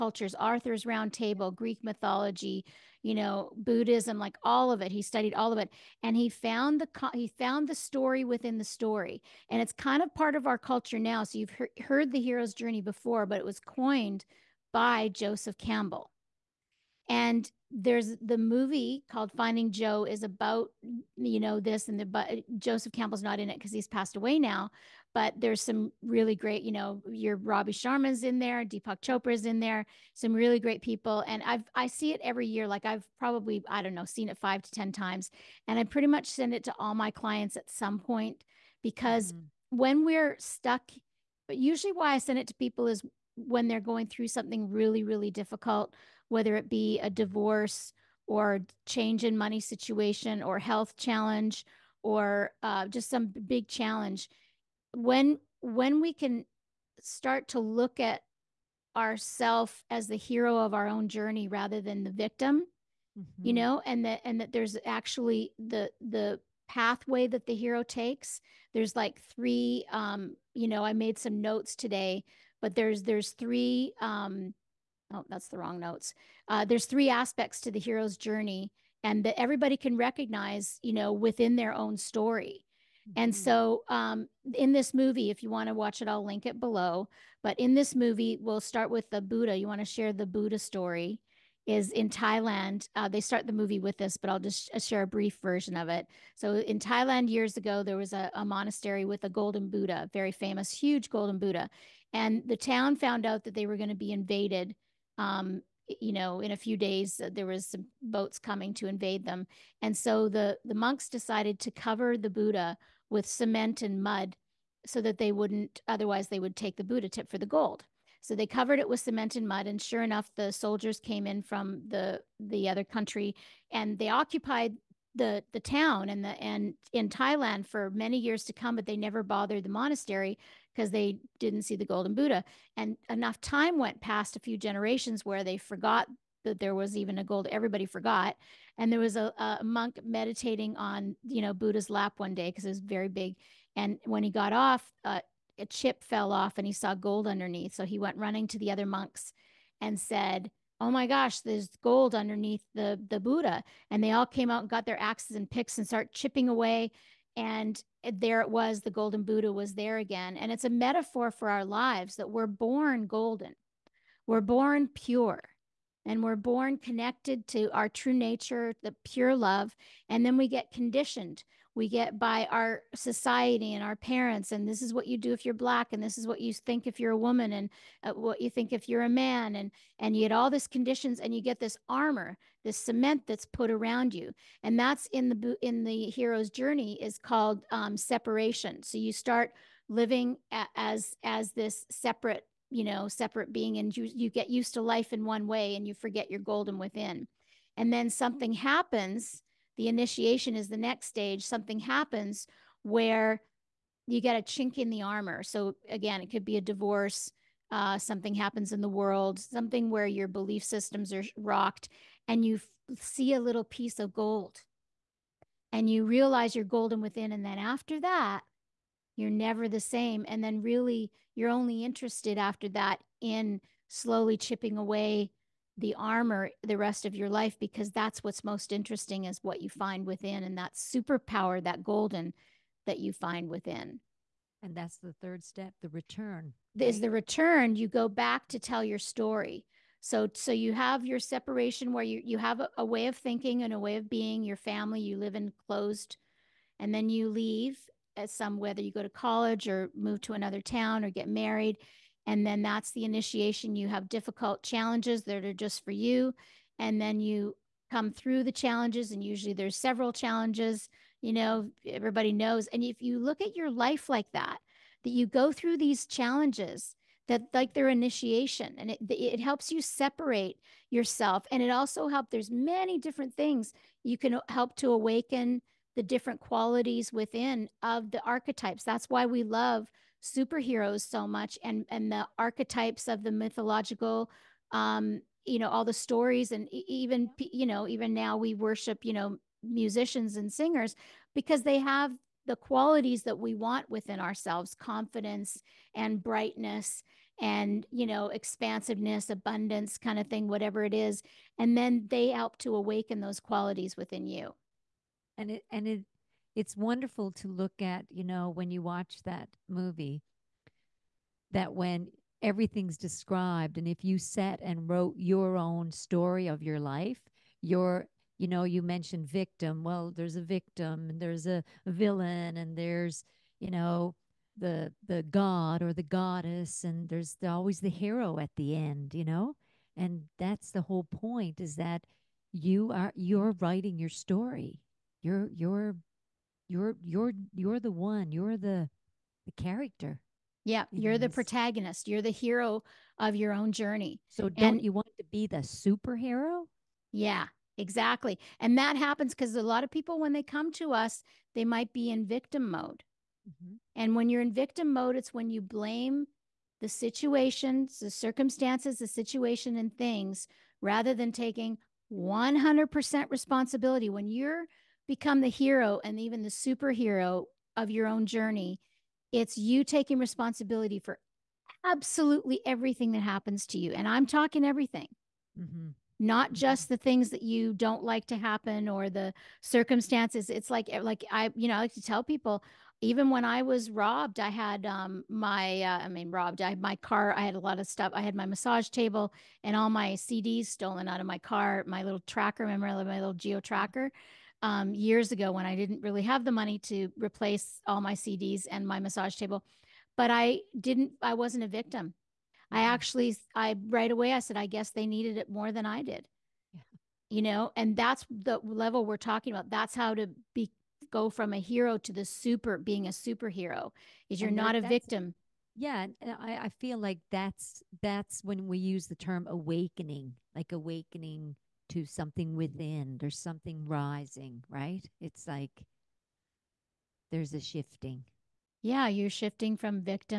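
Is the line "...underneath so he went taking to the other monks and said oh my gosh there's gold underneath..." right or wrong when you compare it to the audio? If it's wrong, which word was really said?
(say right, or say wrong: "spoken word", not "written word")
wrong: "running", not "taking".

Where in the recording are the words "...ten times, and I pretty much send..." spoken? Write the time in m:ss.
0:34.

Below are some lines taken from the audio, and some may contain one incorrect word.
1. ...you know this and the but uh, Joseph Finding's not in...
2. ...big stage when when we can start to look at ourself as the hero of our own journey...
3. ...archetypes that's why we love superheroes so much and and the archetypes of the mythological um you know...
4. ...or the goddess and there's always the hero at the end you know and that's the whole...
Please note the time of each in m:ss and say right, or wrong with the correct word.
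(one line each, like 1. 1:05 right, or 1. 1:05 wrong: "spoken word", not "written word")
1. 0:21 wrong: "Campbell", not "Finding"
2. 0:53 wrong: "challenge", not "stage"
3. 4:38 right
4. 5:25 right.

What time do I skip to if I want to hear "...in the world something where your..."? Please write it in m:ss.
3:28.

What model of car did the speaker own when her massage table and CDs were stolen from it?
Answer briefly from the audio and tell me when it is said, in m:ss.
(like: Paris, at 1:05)
Geo Tracker, at 6:33.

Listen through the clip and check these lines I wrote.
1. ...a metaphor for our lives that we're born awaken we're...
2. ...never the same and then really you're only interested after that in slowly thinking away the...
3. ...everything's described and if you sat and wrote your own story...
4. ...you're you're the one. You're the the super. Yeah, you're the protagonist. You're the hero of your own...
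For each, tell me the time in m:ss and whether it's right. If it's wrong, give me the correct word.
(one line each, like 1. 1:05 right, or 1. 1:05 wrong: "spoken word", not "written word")
1. 2:40 wrong: "golden", not "awaken"
2. 3:39 wrong: "chipping", not "thinking"
3. 5:12 right
4. 5:37 wrong: "character", not "super".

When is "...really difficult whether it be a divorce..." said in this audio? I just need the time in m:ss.
0:45.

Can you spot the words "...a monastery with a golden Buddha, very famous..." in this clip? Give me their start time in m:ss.
1:38.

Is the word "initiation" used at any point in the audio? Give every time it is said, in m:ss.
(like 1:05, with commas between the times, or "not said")
3:19, 4:13, 4:27.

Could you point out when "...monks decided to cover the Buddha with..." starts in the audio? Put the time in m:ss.
1:50.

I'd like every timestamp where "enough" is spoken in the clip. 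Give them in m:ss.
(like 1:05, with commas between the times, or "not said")
2:00, 2:13.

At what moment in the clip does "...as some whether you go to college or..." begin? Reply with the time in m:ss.
4:08.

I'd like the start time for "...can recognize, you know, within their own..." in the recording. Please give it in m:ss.
1:19.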